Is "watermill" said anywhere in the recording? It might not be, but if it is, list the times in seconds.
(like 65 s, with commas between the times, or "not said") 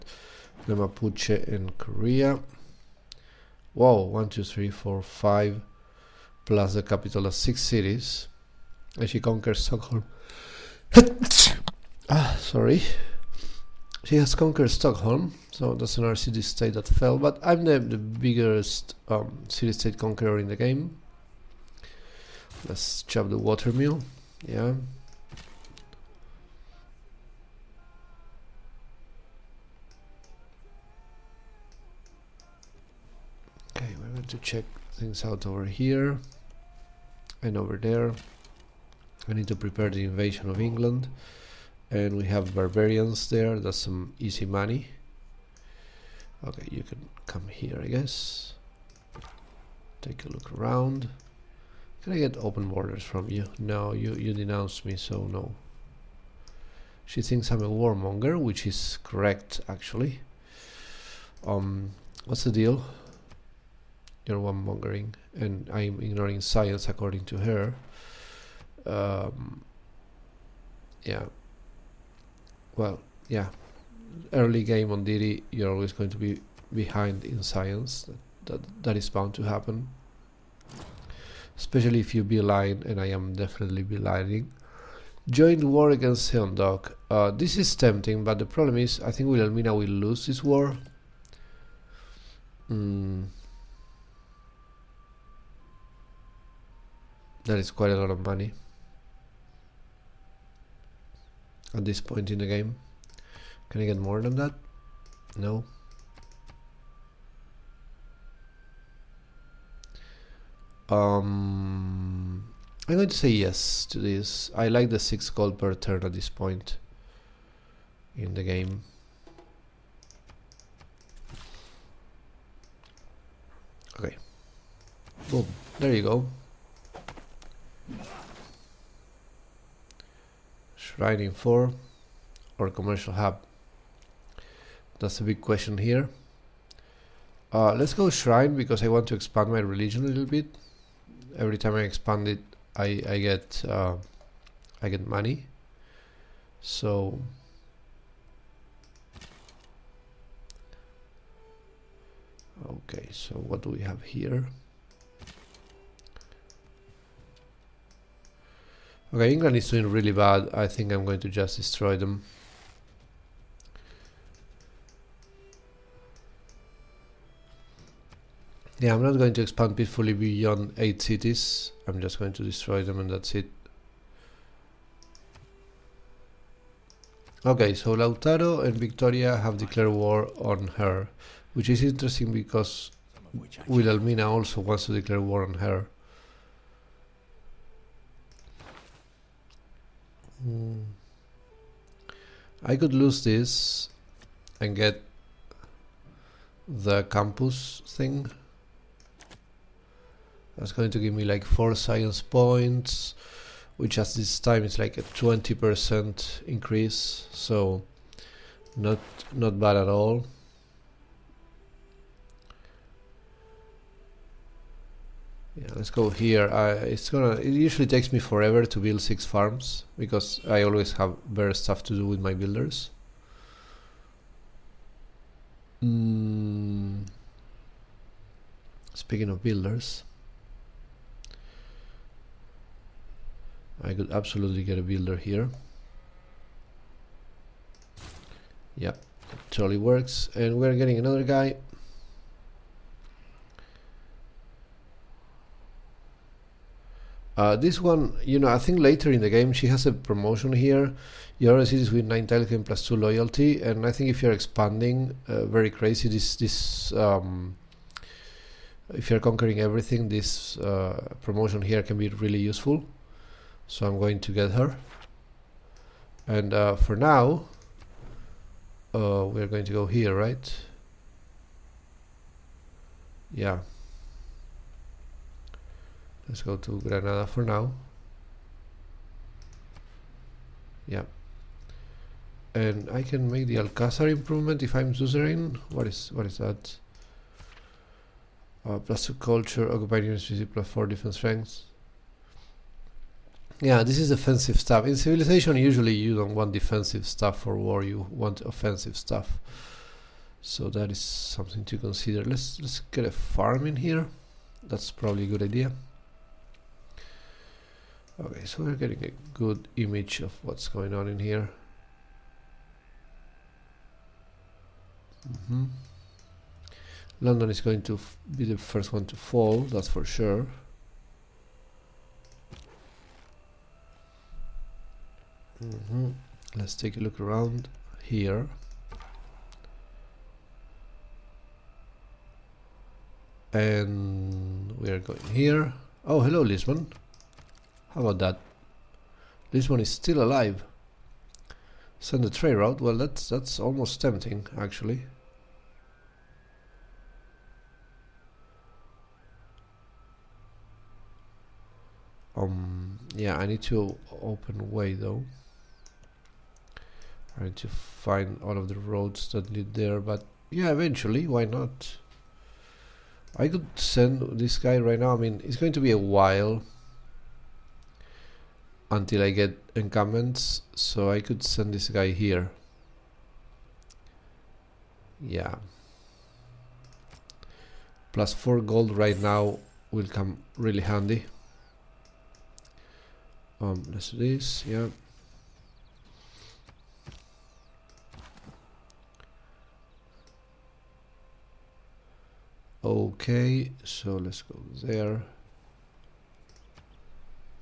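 23 s.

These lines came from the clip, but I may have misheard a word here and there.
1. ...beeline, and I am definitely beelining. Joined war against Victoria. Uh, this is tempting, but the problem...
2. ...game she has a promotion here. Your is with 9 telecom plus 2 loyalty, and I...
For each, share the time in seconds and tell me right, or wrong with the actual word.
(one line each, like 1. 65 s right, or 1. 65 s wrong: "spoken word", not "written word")
1. 82 s wrong: "Seondeok", not "Victoria"
2. 249 s right.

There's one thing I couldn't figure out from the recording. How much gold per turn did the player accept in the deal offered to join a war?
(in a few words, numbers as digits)
6 gold per turn.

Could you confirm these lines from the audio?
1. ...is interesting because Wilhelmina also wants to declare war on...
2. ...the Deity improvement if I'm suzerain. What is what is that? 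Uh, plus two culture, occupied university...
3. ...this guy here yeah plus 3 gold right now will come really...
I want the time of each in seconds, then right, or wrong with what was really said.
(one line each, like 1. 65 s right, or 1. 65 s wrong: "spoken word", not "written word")
1. 181 s right
2. 283 s wrong: "Alcázar", not "Deity"
3. 371 s wrong: "4", not "3".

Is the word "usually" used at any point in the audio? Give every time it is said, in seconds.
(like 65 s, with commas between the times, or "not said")
217 s, 295 s.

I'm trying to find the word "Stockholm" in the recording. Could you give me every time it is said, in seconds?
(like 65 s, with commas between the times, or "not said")
9 s, 14 s.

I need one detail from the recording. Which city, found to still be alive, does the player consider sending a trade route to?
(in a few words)
Lisbon.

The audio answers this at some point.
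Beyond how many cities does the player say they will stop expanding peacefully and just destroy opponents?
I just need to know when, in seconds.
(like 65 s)
170 s.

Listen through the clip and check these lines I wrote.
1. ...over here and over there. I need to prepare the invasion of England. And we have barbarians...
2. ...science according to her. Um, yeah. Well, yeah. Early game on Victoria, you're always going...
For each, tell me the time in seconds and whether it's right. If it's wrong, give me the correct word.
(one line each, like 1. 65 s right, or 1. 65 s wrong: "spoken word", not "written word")
1. 35 s right
2. 66 s wrong: "Deity", not "Victoria".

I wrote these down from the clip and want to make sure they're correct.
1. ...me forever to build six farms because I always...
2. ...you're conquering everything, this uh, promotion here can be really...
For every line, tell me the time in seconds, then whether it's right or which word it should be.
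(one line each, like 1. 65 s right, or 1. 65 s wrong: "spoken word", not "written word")
1. 218 s right
2. 259 s right.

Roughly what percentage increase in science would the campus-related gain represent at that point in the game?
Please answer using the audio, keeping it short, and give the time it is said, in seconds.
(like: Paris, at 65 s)
20%, at 205 s.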